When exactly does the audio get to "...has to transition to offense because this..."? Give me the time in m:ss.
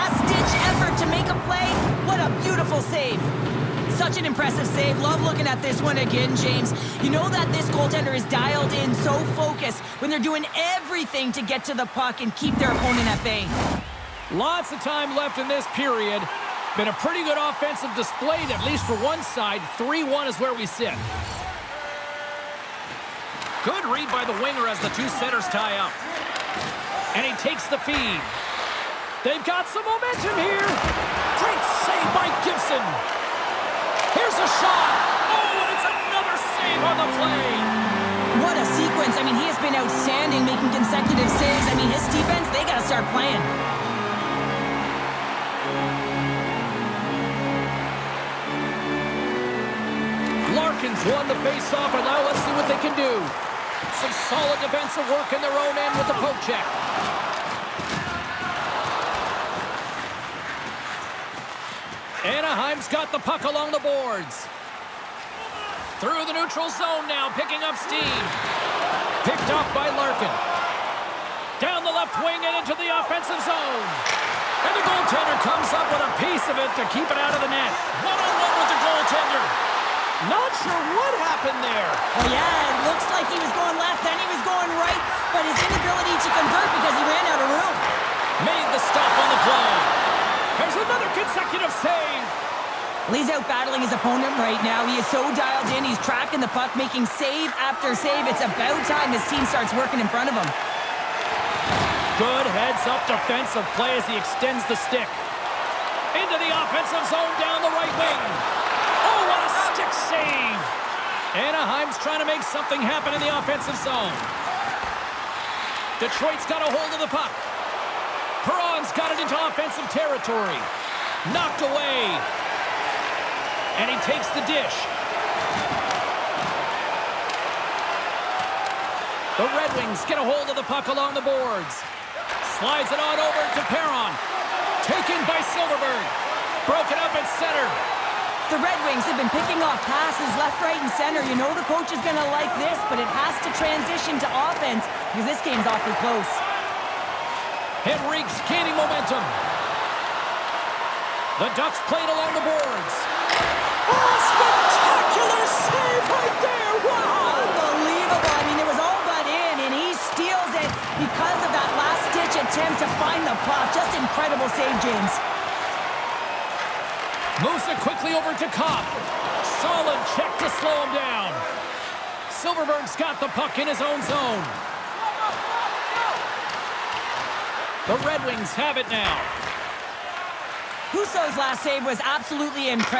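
2:23.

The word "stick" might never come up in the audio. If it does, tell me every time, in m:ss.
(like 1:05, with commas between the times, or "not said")
1:44, 1:49.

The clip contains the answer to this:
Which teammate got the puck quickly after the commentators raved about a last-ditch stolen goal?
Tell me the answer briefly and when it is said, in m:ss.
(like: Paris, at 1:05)
Copp, at 2:48.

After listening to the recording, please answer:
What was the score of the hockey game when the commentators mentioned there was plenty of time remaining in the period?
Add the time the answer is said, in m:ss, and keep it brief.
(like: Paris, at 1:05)
3-1, at 0:19.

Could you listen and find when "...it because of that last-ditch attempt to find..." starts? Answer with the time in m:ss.
2:40.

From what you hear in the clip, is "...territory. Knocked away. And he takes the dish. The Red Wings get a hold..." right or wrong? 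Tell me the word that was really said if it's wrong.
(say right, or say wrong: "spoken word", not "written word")
right.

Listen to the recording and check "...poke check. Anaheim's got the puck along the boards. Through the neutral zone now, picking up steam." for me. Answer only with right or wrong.
right.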